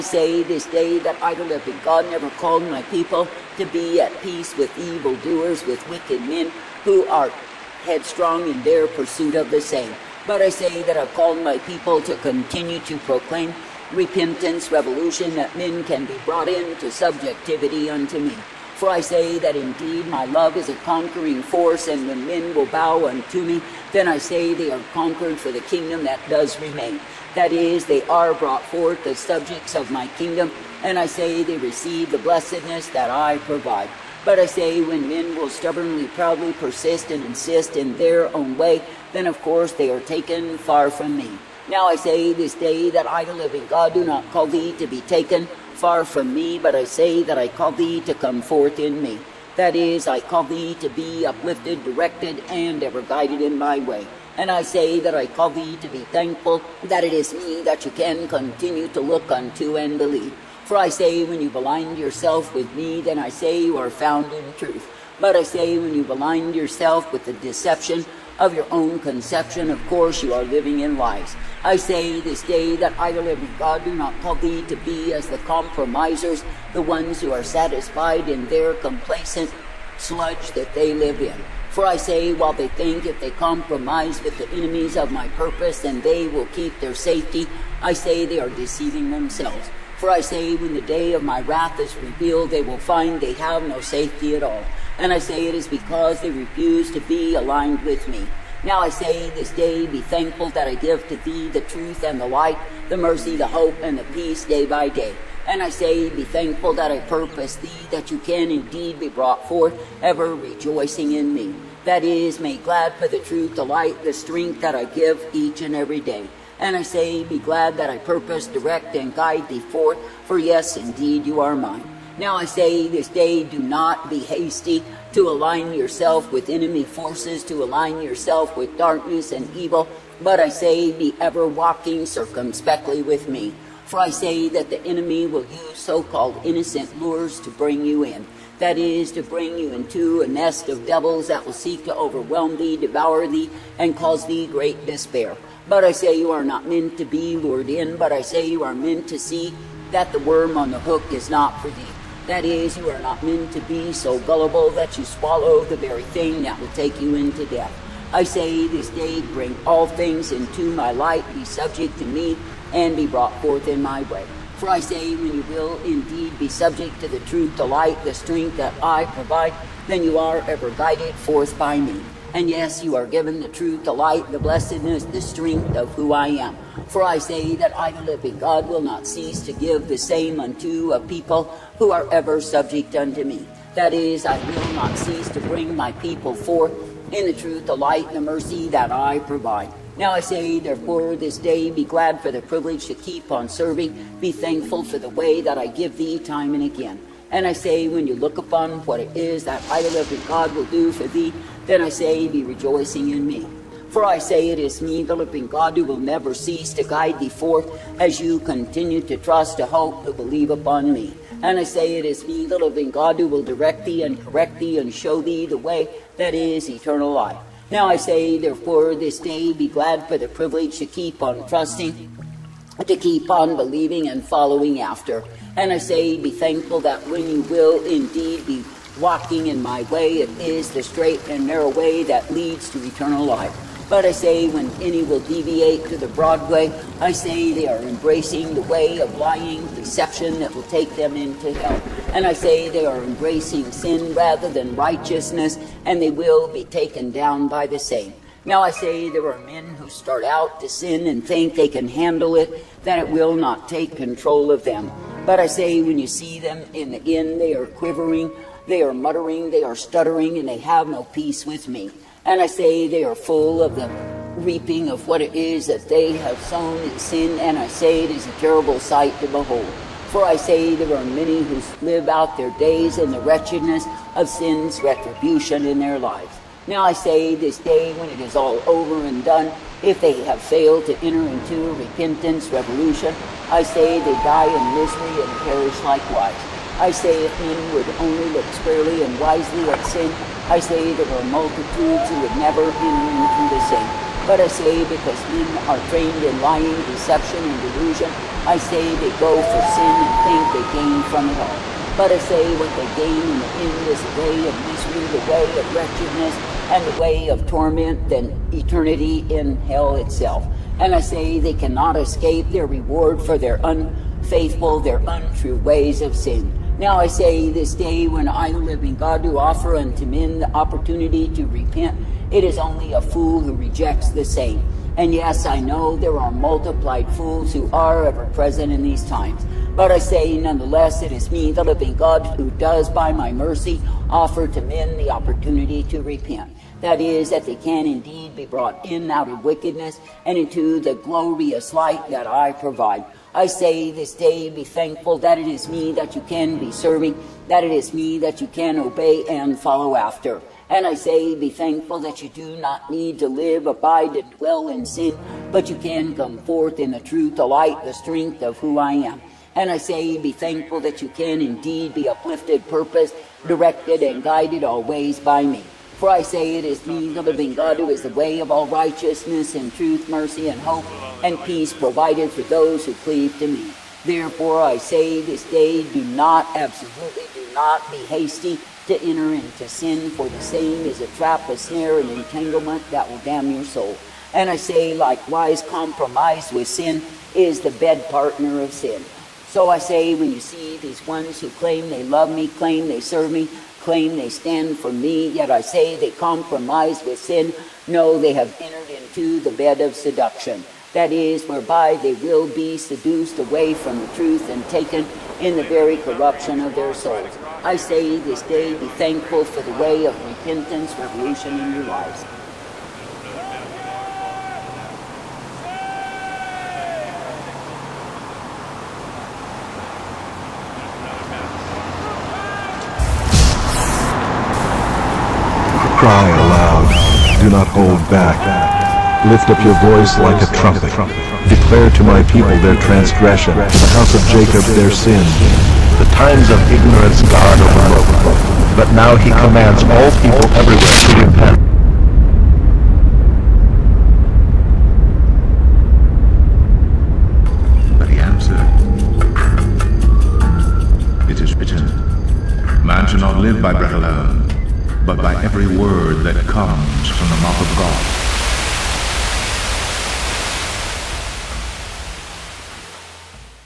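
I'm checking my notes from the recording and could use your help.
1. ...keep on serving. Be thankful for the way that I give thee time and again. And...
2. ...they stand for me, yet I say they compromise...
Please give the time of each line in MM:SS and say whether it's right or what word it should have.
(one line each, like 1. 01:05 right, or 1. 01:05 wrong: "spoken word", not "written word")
1. 03:12 right
2. 06:34 right.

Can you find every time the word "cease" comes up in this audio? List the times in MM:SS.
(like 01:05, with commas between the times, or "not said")
02:59, 03:04, 03:26.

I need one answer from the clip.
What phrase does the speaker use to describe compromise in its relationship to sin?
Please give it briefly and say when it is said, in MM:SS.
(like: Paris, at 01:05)
The bed partner of sin, at 06:27.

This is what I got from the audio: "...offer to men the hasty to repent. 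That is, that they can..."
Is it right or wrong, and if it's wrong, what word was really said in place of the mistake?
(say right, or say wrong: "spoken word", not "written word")
wrong: "opportunity", not "hasty".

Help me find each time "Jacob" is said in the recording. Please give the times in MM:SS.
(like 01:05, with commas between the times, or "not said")
07:14.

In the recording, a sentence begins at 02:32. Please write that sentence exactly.
That is, you are not meant to be so gullible that you swallow the very thing that will take you into death.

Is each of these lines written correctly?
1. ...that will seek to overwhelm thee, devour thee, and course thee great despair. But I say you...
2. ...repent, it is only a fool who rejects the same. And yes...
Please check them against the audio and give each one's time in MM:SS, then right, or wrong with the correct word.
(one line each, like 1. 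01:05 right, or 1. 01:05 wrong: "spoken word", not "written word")
1. 02:21 wrong: "cause", not "course"
2. 05:21 right.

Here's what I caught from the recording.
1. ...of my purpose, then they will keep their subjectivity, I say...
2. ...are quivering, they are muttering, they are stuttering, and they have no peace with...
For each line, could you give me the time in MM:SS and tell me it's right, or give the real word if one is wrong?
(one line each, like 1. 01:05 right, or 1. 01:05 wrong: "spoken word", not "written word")
1. 01:24 wrong: "safety", not "subjectivity"
2. 04:17 right.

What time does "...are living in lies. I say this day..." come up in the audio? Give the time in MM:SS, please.
01:10.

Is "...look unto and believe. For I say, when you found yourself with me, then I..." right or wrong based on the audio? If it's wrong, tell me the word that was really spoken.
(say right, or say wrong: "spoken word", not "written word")
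wrong: "blind", not "found".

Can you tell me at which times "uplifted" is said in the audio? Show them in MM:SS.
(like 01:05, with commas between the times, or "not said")
00:51, 06:02.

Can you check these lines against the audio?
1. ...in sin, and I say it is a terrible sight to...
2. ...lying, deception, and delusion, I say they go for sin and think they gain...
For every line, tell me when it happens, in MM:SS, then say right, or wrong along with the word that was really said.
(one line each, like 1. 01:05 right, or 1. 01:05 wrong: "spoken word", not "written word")
1. 04:26 right
2. 04:56 right.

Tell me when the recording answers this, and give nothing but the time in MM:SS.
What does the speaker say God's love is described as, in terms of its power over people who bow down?
00:20.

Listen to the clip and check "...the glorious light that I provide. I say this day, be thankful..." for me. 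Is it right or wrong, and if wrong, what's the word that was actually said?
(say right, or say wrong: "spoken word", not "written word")
right.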